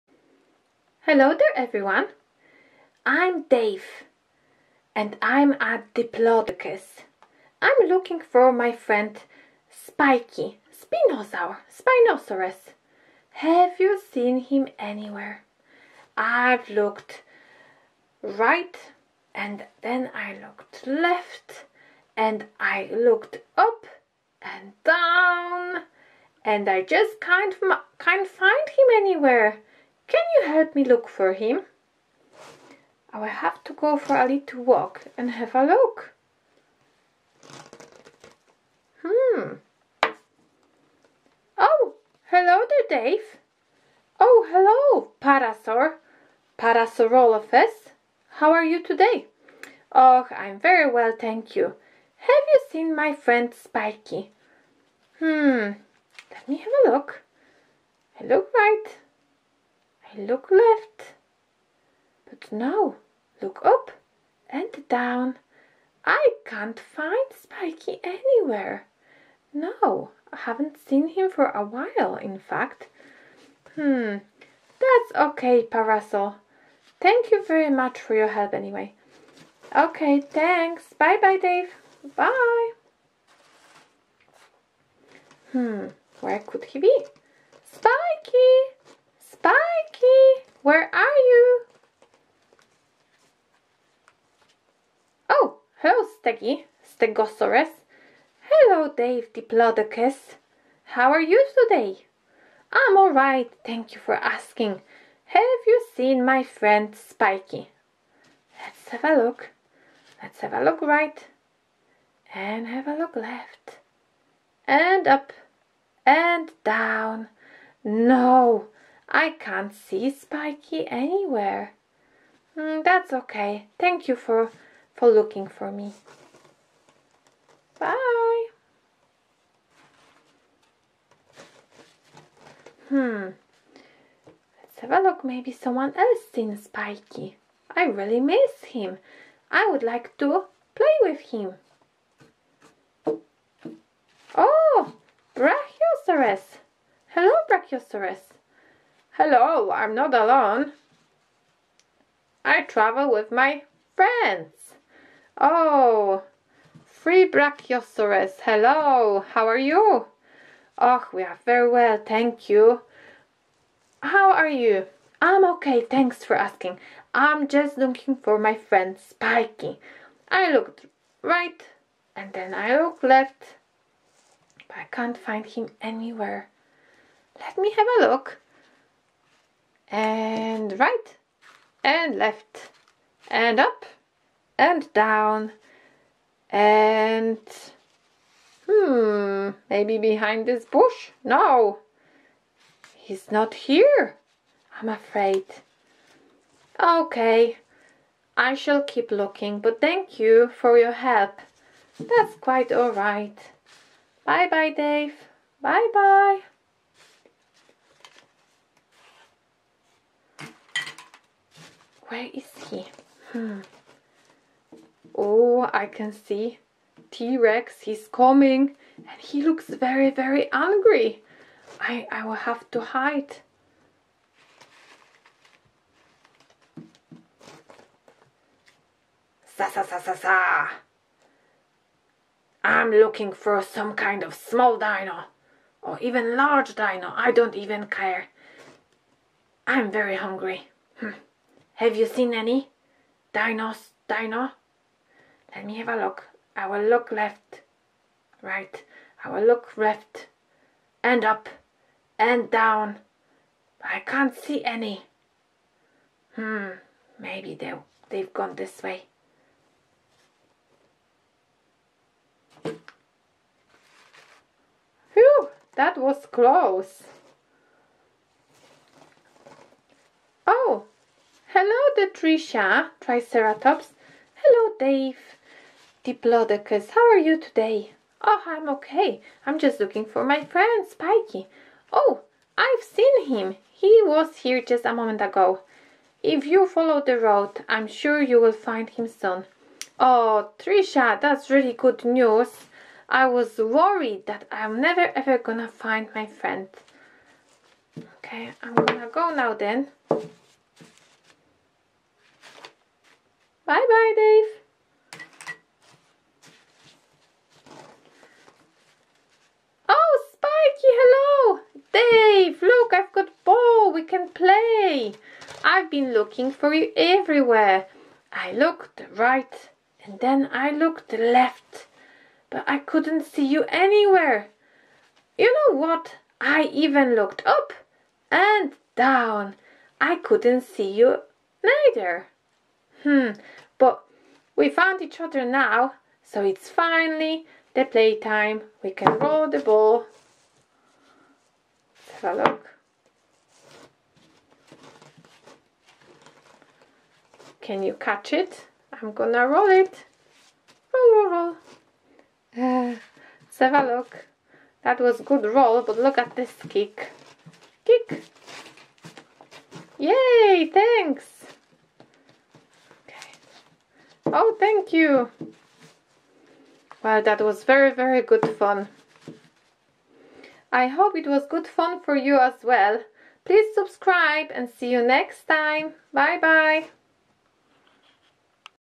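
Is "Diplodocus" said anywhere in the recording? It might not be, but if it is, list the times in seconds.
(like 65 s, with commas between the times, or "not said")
5 s, 99 s, 276 s.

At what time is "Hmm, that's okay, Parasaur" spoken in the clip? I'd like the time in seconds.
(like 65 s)
73 s.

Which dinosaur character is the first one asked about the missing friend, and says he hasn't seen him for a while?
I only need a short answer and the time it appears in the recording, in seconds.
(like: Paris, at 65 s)
Parasaurolophus, at 46 s.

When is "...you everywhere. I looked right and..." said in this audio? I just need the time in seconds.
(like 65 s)
316 s.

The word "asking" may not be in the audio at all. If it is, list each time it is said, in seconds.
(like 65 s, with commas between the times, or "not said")
104 s, 166 s.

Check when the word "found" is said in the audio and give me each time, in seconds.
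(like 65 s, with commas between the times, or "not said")
334 s.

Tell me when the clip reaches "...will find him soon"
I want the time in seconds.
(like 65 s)
288 s.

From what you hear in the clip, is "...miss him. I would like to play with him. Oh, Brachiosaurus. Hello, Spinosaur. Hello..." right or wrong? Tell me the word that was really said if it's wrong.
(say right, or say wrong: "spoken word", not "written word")
wrong: "Brachiosaurus", not "Spinosaur".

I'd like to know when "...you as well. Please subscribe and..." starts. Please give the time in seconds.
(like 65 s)
372 s.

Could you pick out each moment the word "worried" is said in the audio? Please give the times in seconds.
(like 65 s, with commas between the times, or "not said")
293 s.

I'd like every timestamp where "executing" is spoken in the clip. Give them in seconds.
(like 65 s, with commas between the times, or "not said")
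not said.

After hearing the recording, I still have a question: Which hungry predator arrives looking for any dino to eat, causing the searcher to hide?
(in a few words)
T-Rex.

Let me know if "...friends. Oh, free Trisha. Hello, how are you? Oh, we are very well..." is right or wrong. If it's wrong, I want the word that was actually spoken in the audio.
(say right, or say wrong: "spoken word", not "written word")
wrong: "Brachiosaurus", not "Trisha".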